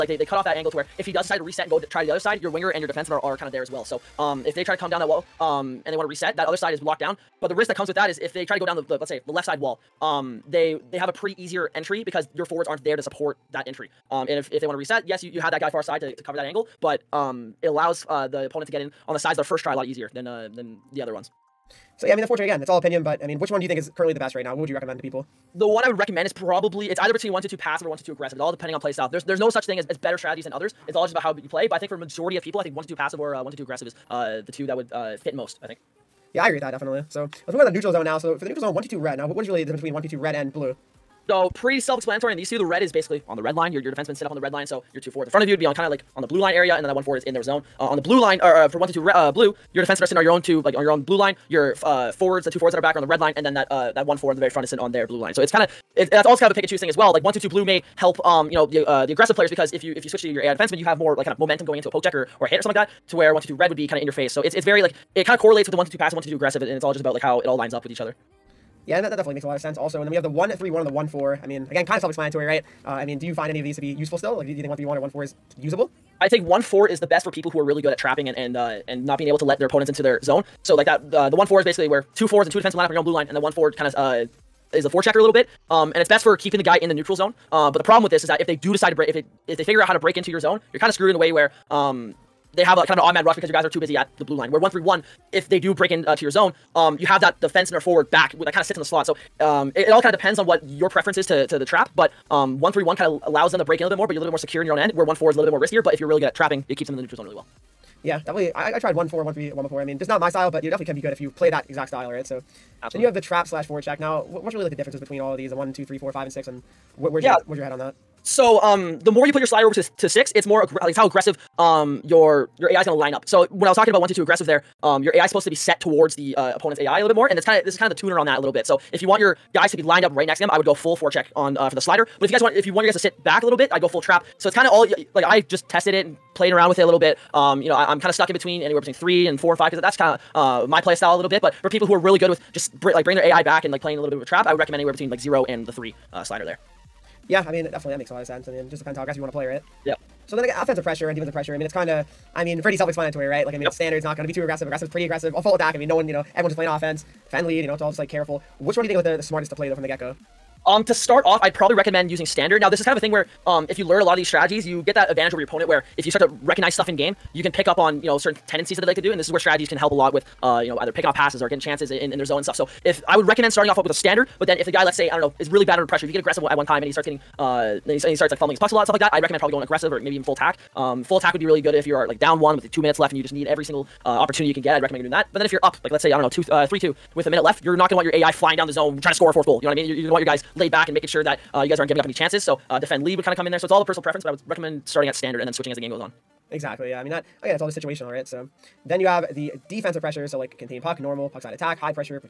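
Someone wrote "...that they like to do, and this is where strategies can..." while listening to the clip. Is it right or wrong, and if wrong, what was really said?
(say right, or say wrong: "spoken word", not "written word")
right.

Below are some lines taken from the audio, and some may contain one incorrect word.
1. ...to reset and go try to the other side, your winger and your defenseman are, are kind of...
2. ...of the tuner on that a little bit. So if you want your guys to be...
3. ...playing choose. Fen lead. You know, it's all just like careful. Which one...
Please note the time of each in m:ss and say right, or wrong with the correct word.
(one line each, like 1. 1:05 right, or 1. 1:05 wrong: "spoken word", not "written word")
1. 0:01 right
2. 2:07 right
3. 2:36 wrong: "offense", not "choose".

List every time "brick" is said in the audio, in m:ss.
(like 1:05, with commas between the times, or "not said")
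not said.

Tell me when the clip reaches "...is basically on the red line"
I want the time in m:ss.
0:42.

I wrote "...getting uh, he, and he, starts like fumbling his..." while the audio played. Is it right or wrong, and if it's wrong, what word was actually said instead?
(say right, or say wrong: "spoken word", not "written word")
right.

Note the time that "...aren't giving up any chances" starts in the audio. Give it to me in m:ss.
3:11.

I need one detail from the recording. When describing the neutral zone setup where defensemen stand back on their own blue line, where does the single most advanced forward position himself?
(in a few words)
Their blue line.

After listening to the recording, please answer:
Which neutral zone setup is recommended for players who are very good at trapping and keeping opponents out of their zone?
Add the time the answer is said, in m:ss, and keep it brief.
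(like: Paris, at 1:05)
1-4, at 1:16.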